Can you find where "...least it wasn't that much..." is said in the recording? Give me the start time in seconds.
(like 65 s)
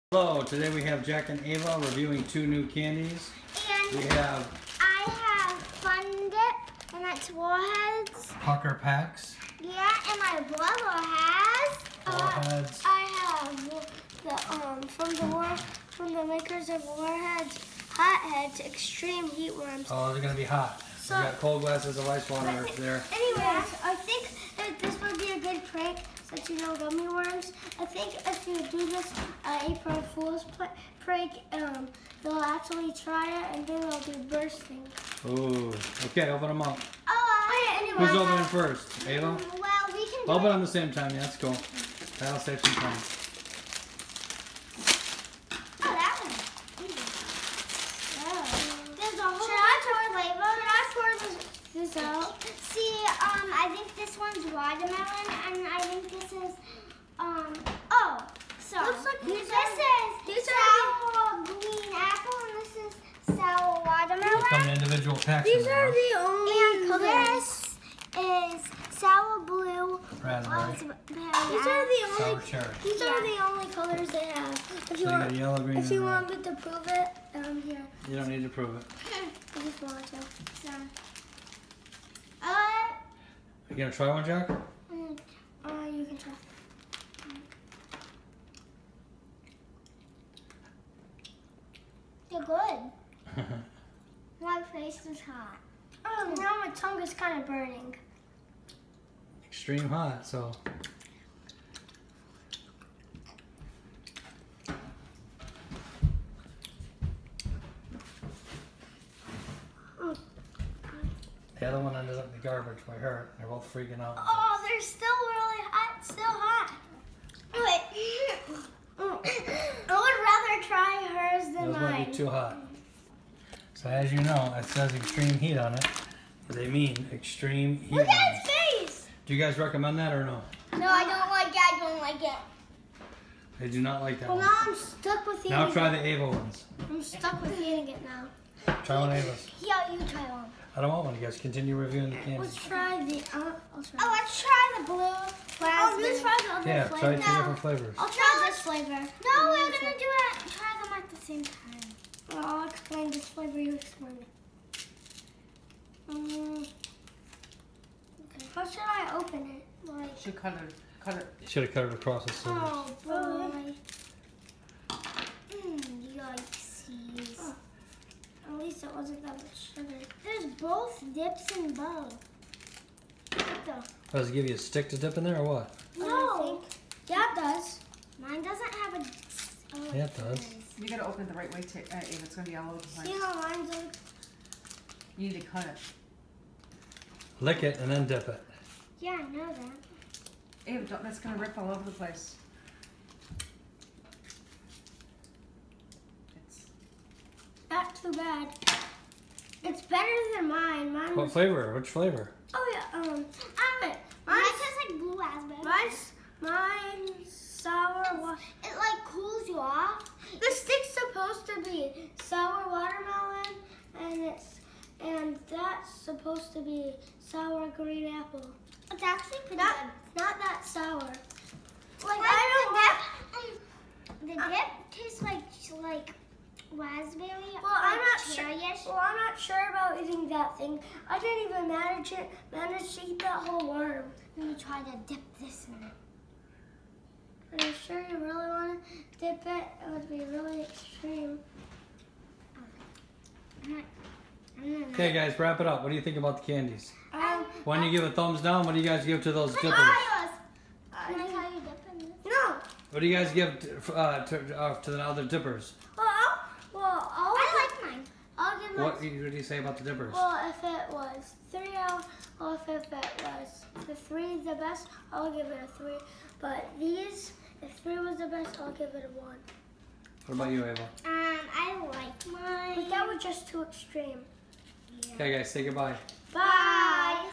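168 s.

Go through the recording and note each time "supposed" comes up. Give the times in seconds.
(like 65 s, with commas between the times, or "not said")
211 s, 215 s.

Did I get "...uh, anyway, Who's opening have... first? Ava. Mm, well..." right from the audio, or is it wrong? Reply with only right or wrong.
right.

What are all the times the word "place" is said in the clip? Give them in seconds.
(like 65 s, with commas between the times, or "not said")
182 s, 191 s.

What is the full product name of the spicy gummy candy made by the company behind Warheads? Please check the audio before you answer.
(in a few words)
Hotheads Extreme Heat Worms.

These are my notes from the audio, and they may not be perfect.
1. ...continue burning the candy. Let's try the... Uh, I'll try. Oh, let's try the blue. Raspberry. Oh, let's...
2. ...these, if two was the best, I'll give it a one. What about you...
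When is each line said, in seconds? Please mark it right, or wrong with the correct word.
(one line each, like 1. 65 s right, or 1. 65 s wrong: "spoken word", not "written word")
1. 141 s wrong: "reviewing", not "burning"
2. 266 s wrong: "three", not "two".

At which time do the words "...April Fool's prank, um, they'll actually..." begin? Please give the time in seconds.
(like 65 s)
29 s.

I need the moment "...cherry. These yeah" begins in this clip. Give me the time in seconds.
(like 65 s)
72 s.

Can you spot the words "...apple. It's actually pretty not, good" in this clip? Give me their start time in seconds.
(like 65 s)
218 s.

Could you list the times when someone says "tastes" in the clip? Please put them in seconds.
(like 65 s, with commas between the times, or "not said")
204 s, 224 s.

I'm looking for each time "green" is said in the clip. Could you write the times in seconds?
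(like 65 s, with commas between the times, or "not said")
61 s, 75 s, 217 s.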